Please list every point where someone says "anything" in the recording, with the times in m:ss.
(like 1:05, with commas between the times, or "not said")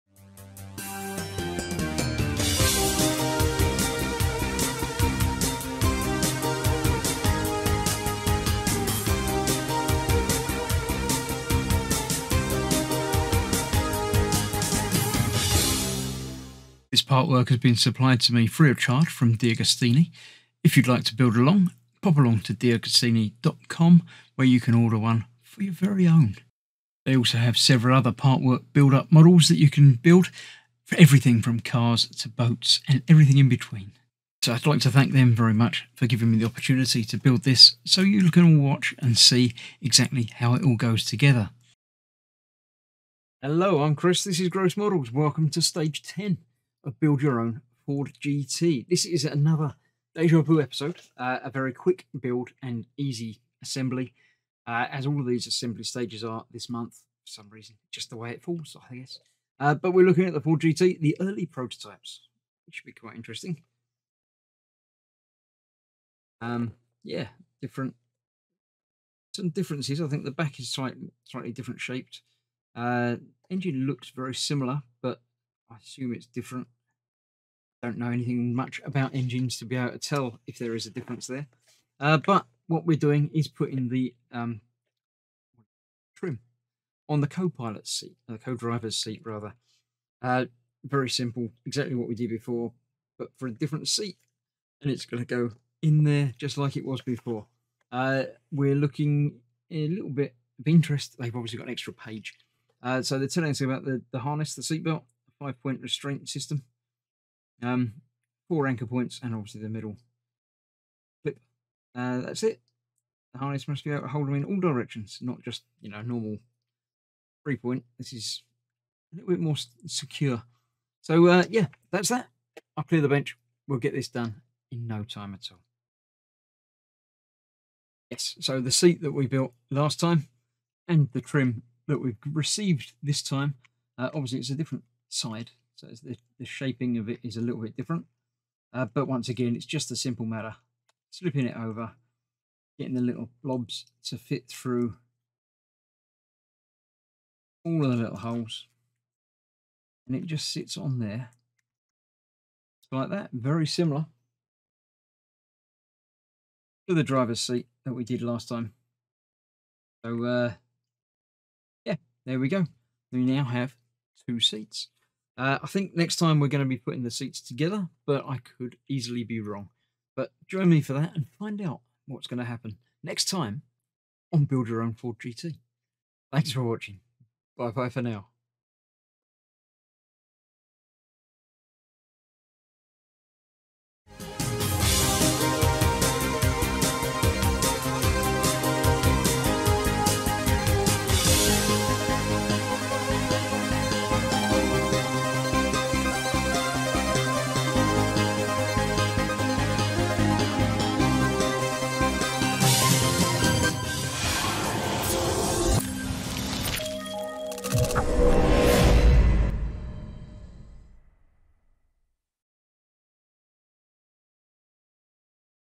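1:18.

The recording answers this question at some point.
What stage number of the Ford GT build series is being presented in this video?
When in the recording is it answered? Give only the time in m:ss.
0:45.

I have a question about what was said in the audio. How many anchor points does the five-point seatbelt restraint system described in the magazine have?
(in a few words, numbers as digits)
4.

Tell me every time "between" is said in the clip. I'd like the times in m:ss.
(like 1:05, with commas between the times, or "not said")
0:33.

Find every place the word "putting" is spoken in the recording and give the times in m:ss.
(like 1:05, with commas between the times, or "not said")
1:23, 2:46.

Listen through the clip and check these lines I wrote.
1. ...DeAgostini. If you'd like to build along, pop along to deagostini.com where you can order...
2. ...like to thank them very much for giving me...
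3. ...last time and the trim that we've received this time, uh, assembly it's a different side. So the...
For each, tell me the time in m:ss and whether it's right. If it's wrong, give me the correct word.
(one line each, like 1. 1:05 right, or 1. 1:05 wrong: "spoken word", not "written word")
1. 0:19 right
2. 0:34 right
3. 2:09 wrong: "obviously", not "assembly".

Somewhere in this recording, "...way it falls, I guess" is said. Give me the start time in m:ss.
0:58.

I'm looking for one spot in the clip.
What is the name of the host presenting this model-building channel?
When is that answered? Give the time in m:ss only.
0:43.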